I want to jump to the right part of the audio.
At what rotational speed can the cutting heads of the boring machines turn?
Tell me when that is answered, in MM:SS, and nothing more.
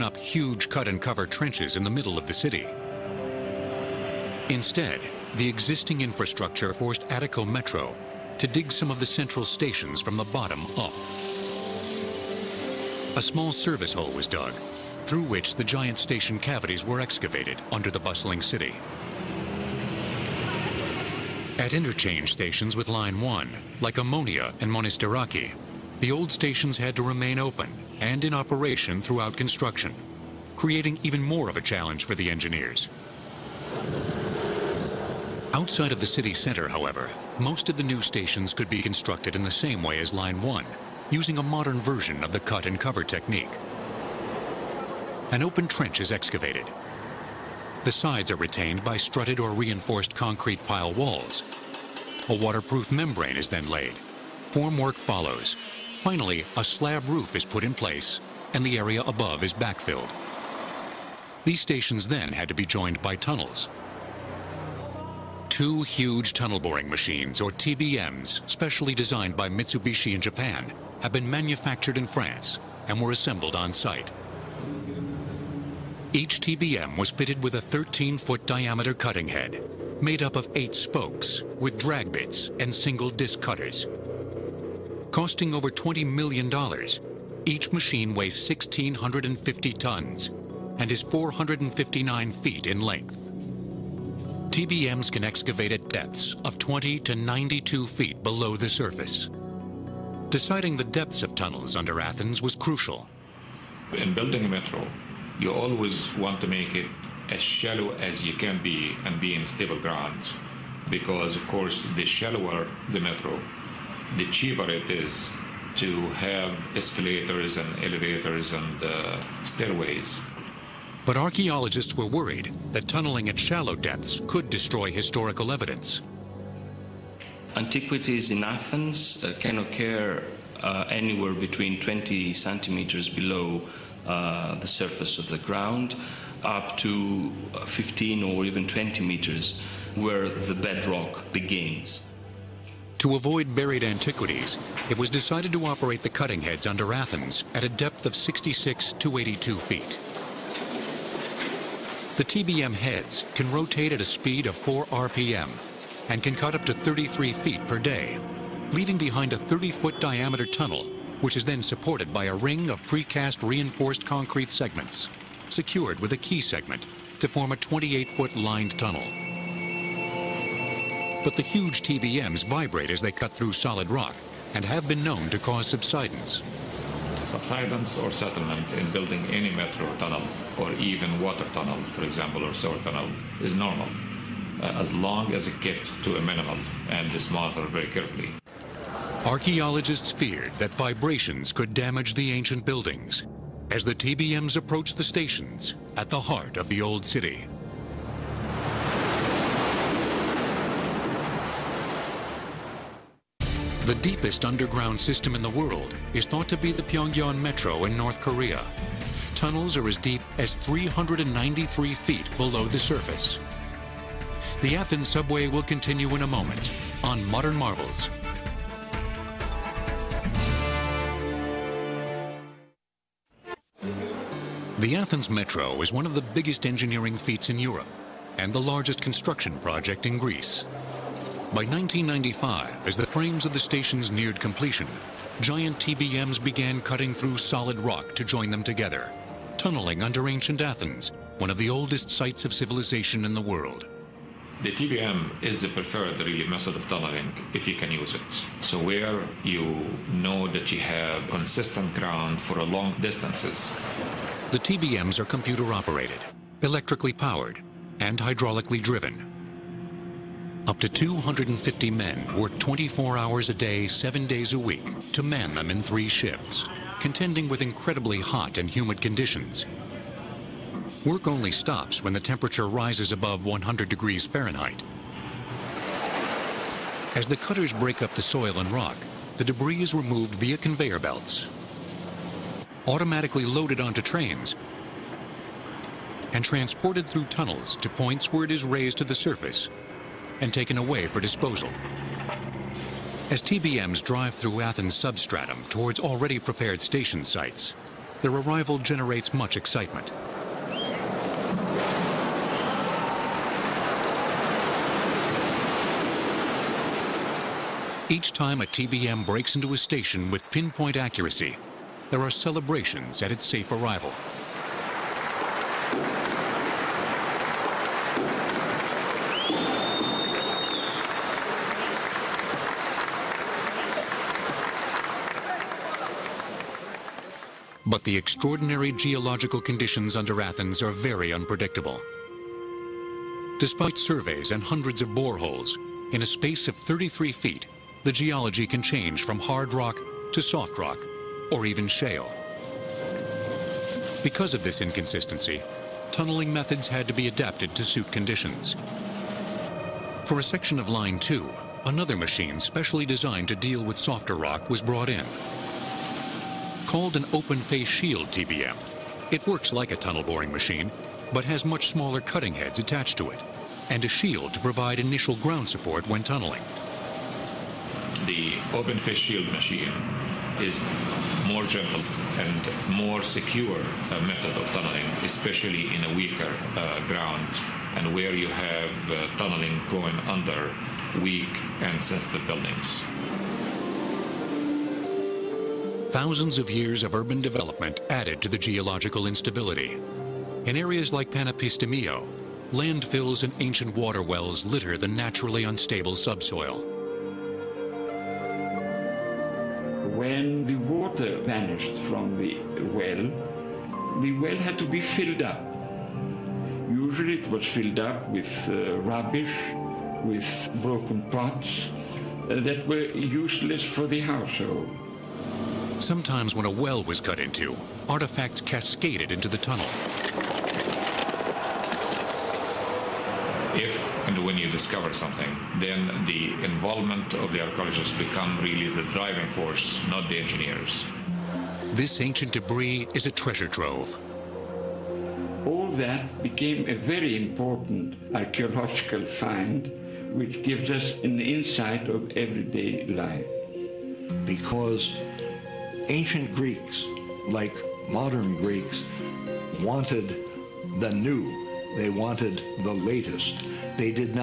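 02:34.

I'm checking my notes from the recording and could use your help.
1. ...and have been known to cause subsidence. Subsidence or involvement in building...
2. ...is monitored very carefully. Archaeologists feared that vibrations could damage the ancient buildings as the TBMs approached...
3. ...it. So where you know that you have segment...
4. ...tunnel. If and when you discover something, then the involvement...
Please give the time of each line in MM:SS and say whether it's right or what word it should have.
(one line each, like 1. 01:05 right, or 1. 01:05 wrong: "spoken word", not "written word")
1. 02:54 wrong: "settlement", not "involvement"
2. 03:07 right
3. 04:08 wrong: "consistent", not "segment"
4. 06:59 right.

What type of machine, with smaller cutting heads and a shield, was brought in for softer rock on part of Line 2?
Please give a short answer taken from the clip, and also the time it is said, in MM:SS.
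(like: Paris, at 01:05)
open face shield TBM, at 05:57.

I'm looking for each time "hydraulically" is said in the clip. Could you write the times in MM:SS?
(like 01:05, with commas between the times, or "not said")
04:18.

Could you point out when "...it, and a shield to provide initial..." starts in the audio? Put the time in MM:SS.
06:03.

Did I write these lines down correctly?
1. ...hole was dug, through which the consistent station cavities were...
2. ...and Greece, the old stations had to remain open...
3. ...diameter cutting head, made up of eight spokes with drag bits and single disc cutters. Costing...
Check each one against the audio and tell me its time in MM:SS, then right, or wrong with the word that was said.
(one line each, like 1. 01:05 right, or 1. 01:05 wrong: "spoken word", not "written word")
1. 00:13 wrong: "giant", not "consistent"
2. 00:24 wrong: "Monastiraki", not "Greece"
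3. 01:18 right.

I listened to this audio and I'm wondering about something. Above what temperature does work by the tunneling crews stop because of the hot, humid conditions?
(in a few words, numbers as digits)
100 degrees Fahrenheit.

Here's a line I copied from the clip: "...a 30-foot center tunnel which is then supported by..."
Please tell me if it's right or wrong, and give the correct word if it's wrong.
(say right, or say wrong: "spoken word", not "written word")
wrong: "diameter", not "center".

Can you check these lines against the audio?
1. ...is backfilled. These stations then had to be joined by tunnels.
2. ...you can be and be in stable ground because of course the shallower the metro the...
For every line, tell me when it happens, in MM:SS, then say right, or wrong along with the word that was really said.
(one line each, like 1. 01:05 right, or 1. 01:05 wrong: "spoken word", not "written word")
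1. 00:59 right
2. 01:48 right.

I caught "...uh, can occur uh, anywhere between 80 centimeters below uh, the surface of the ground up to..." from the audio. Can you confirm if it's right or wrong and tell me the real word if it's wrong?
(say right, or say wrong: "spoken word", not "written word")
wrong: "20", not "80".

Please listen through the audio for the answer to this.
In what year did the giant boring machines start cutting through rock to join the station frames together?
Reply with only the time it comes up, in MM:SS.
03:51.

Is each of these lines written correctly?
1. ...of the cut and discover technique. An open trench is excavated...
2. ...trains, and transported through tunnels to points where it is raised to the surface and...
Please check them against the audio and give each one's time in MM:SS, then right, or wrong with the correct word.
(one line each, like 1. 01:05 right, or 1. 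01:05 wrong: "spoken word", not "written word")
1. 00:42 wrong: "cover", not "discover"
2. 04:44 right.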